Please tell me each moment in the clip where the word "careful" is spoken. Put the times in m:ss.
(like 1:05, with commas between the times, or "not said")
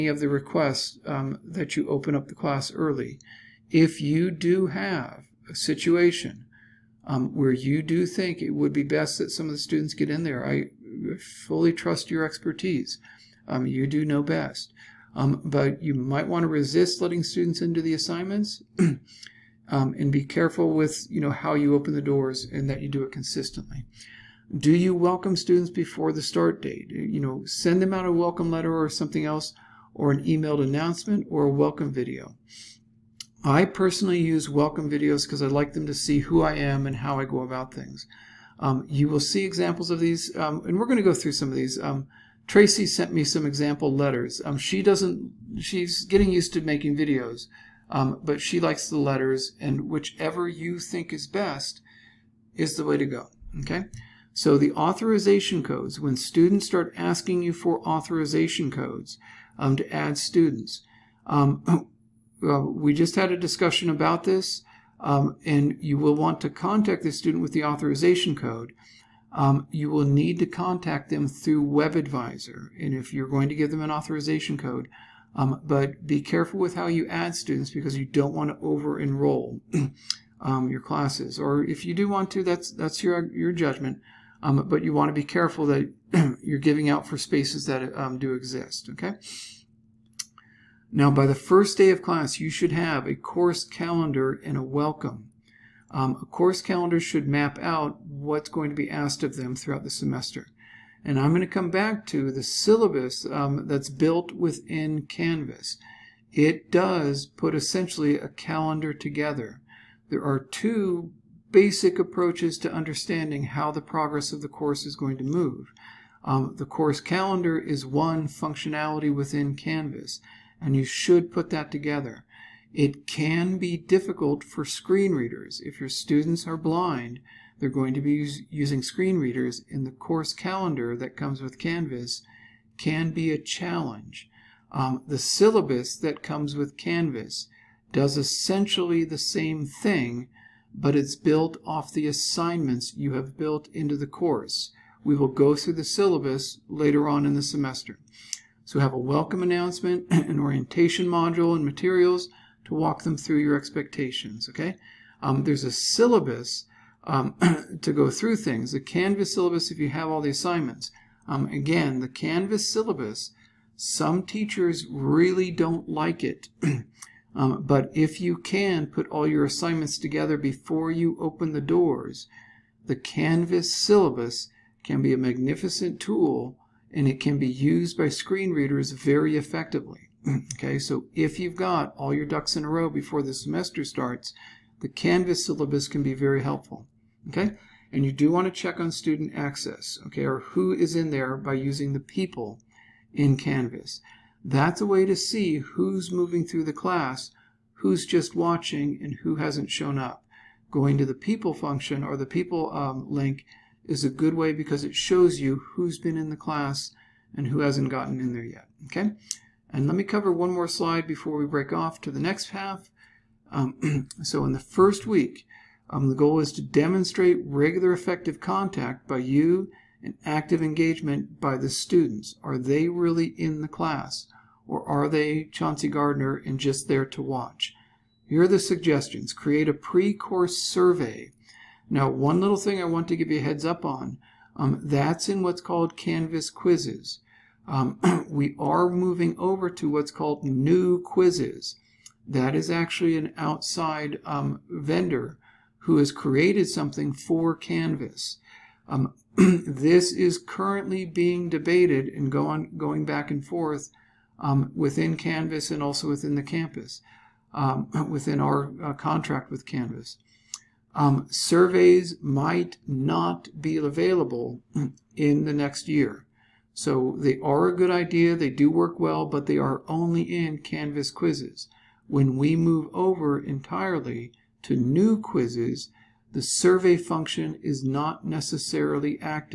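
0:20, 1:16, 1:25.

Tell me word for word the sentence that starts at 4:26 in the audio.
So they are a good idea, they do work well, but they are only in Canvas quizzes.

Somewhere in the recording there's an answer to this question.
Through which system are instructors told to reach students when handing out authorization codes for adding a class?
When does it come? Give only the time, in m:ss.
1:11.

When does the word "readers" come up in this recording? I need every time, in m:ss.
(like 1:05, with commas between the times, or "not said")
2:05, 2:09, 2:58.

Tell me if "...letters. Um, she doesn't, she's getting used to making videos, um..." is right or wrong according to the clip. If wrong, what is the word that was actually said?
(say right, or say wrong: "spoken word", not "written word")
right.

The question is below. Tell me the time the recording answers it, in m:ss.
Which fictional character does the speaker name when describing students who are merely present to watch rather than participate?
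3:45.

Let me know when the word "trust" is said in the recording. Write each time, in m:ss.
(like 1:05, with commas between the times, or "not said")
0:11.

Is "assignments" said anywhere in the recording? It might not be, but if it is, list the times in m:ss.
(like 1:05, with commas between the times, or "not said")
0:17, 2:22, 2:40, 2:49.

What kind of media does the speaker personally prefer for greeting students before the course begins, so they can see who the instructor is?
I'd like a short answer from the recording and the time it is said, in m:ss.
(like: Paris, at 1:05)
Welcome videos, at 0:34.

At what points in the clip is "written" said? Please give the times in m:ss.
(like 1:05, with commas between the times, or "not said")
not said.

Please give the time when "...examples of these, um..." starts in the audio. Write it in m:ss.
0:39.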